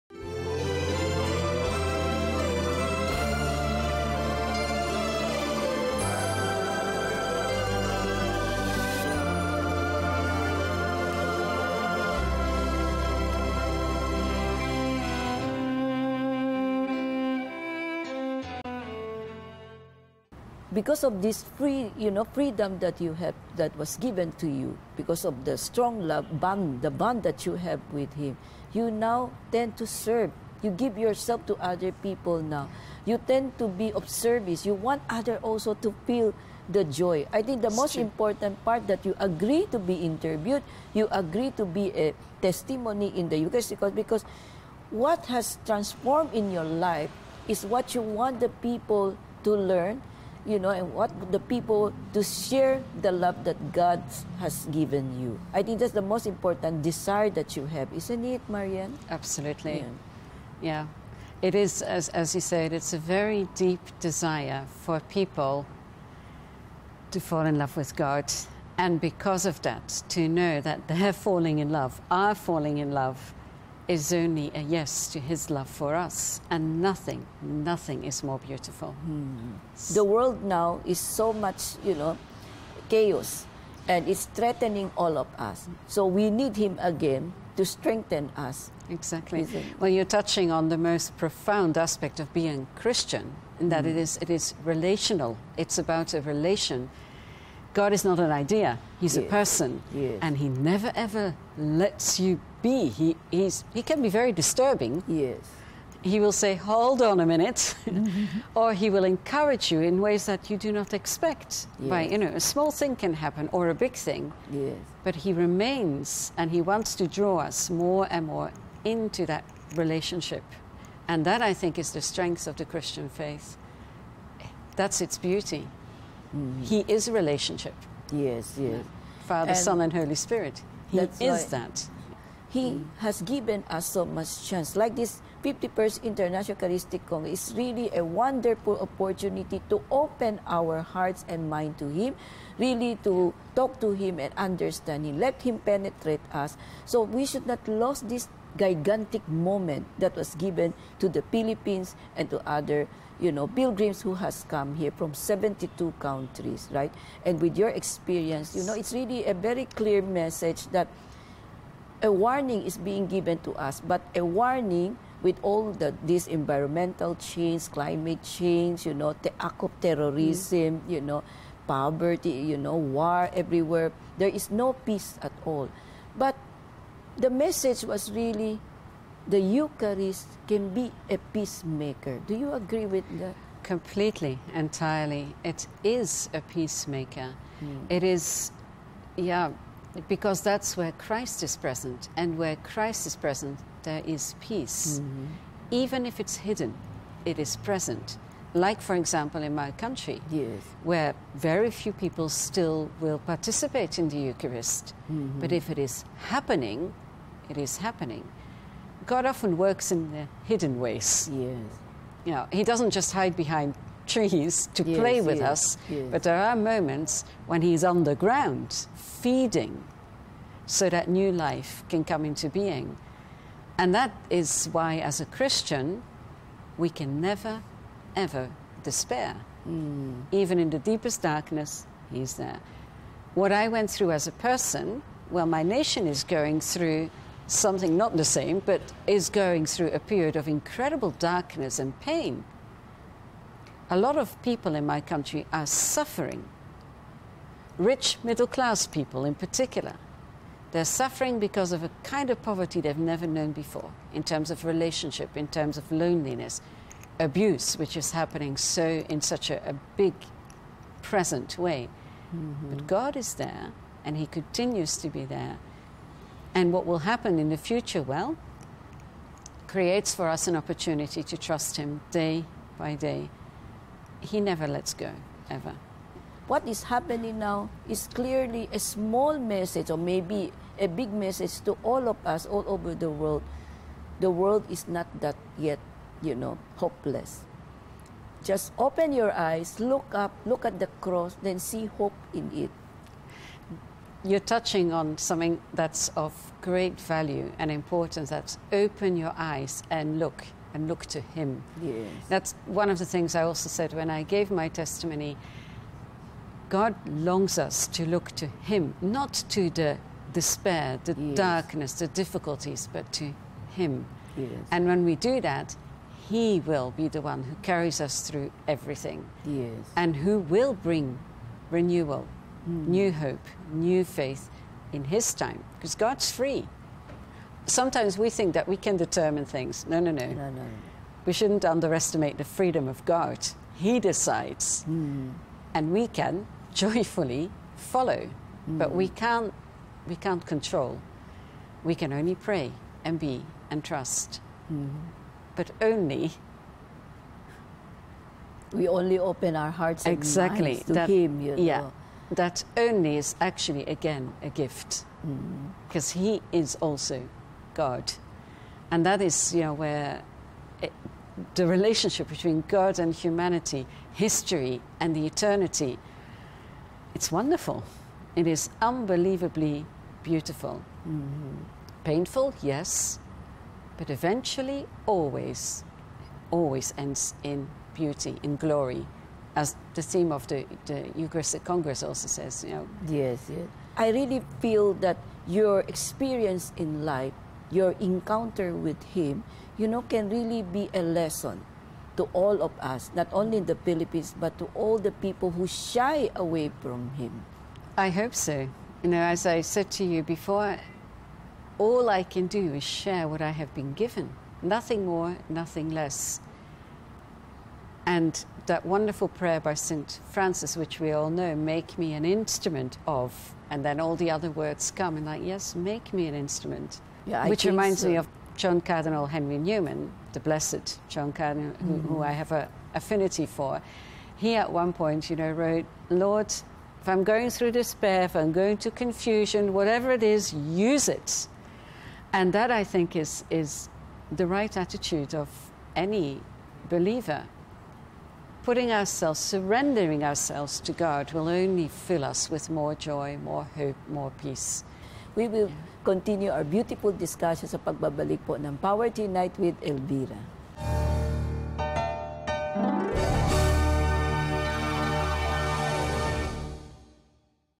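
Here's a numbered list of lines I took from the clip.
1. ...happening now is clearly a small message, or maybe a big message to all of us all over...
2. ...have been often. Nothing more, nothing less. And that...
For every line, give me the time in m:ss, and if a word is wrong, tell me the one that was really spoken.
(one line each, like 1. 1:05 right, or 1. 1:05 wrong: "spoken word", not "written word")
1. 4:36 right
2. 6:43 wrong: "given", not "often".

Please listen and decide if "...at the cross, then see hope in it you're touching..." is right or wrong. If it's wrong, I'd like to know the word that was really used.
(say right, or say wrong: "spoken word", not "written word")
right.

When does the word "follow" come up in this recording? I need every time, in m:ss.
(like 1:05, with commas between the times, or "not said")
5:37.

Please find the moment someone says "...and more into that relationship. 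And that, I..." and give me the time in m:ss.
1:58.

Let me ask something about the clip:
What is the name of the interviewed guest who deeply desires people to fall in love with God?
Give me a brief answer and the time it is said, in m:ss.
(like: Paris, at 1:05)
Marianne, at 0:58.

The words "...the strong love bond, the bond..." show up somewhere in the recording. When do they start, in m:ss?
0:25.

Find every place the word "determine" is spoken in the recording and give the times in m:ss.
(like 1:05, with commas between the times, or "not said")
5:28.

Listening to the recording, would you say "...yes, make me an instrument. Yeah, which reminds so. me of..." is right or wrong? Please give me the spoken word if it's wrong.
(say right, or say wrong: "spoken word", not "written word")
right.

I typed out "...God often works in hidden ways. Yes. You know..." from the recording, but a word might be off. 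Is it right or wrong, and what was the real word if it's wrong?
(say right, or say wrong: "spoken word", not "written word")
right.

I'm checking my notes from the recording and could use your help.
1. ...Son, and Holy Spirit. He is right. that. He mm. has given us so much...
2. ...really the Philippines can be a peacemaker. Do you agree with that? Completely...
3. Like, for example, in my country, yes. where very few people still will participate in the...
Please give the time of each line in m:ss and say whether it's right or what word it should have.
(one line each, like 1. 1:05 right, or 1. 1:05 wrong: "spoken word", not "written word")
1. 2:09 right
2. 2:58 wrong: "Eucharist", not "Philippines"
3. 3:18 right.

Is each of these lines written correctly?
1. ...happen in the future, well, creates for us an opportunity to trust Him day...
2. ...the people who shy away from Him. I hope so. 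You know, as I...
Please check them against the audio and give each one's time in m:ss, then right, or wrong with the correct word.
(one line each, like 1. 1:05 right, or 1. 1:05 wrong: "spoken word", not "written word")
1. 4:27 right
2. 6:34 right.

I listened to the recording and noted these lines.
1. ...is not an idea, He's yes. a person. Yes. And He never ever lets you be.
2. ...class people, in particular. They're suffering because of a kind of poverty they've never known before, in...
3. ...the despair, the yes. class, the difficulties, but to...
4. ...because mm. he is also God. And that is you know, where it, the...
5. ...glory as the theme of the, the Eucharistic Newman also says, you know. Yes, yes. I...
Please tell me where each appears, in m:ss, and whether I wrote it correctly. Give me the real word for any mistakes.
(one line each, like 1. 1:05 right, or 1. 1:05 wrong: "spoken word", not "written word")
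1. 1:37 right
2. 4:08 right
3. 5:09 wrong: "darkness", not "class"
4. 5:55 right
5. 6:18 wrong: "Congress", not "Newman".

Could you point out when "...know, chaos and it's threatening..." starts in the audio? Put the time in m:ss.
1:21.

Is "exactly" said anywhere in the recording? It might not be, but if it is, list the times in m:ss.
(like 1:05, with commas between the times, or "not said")
1:28, 5:50.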